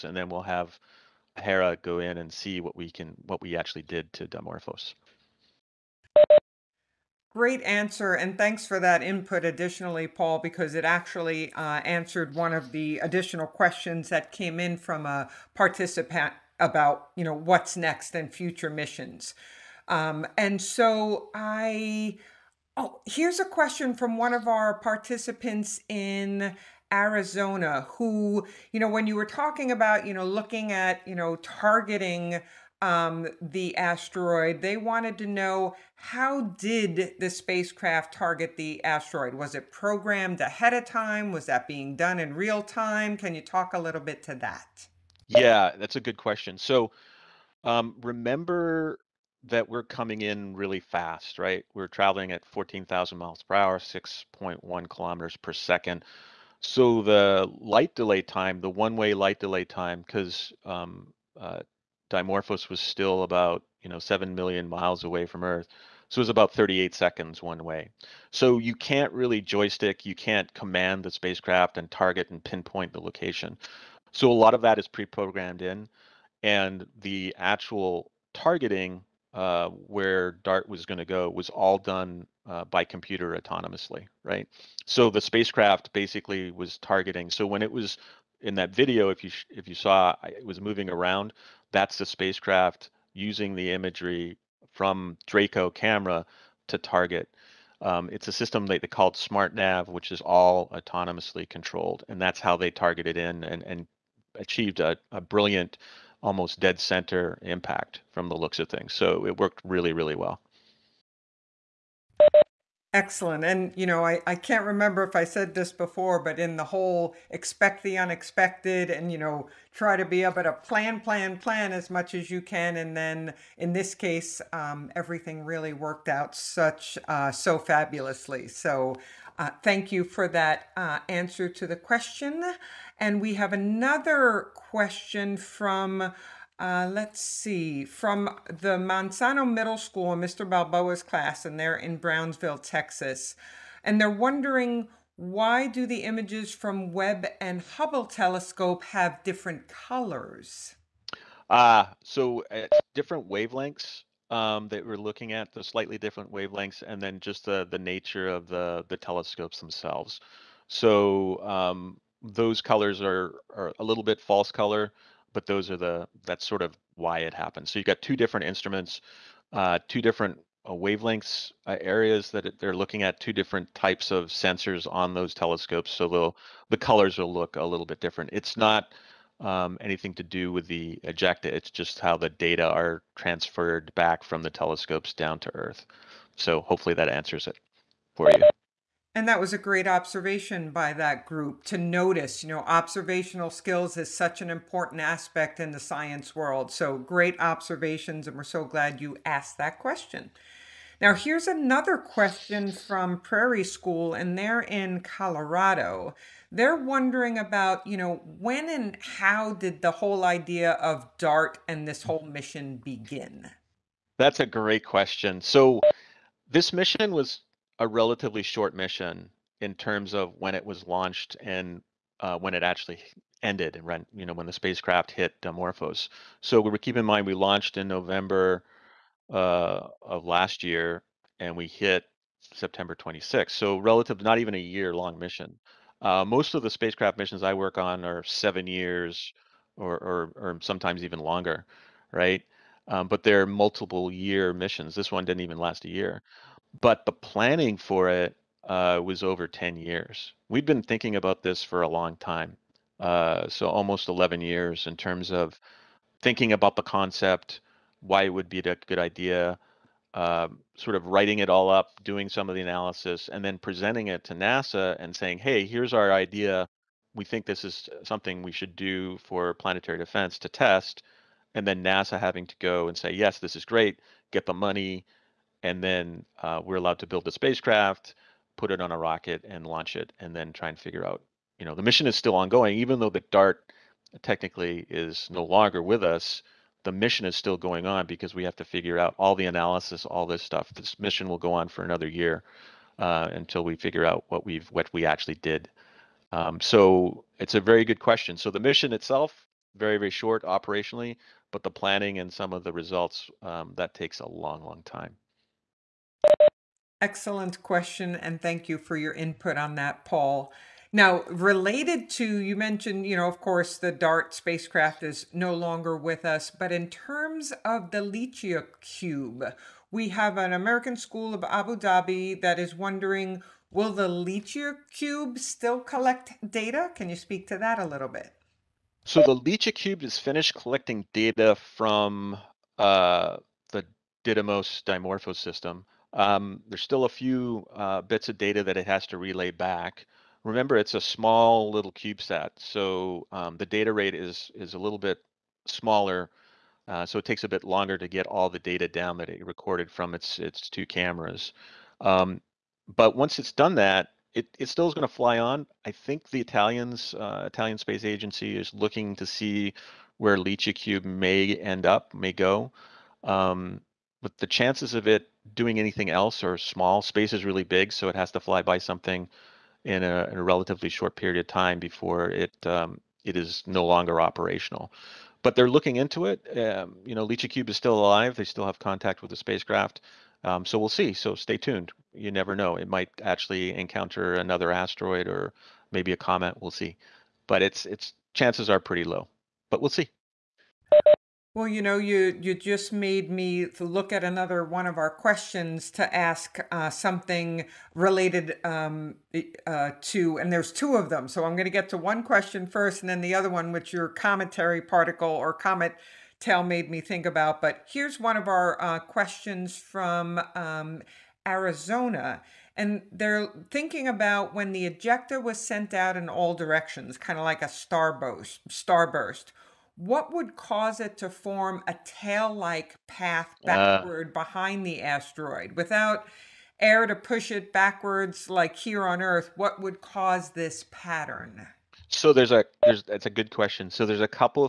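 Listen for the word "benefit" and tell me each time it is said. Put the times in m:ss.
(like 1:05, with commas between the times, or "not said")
not said.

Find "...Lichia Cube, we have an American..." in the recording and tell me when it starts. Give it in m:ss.
5:18.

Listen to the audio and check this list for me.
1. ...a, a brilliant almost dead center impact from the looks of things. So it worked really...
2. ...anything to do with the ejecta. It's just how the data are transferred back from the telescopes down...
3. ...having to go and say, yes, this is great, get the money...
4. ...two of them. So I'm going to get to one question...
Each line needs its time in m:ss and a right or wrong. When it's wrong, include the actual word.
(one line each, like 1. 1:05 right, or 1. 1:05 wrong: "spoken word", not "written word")
1. 1:44 right
2. 2:59 right
3. 4:32 right
4. 6:40 right.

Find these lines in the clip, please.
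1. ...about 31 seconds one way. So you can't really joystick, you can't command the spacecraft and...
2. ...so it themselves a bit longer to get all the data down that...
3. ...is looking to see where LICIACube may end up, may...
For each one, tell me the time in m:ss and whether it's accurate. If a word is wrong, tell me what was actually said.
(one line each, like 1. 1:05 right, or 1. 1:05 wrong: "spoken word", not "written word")
1. 1:06 wrong: "38", not "31"
2. 5:47 wrong: "takes", not "themselves"
3. 5:58 right.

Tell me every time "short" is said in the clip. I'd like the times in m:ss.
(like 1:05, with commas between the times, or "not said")
3:38, 5:00, 6:10.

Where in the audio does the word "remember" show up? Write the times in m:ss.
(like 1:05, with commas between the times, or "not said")
0:48, 1:54, 5:40.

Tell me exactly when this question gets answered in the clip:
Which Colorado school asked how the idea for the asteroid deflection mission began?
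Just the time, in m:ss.
3:23.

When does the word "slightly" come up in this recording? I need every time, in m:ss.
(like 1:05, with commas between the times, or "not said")
2:35.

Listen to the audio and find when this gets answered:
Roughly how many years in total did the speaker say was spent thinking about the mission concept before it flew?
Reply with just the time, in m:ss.
4:14.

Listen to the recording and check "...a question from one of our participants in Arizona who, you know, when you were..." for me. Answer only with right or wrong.
right.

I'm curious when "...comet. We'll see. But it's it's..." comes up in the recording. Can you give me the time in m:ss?
6:26.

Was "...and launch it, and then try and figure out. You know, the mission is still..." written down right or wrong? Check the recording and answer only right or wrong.
right.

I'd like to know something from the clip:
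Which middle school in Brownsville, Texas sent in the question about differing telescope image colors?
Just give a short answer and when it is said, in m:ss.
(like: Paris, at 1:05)
Monsanto Middle School, at 2:18.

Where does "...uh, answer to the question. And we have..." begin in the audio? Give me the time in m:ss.
2:10.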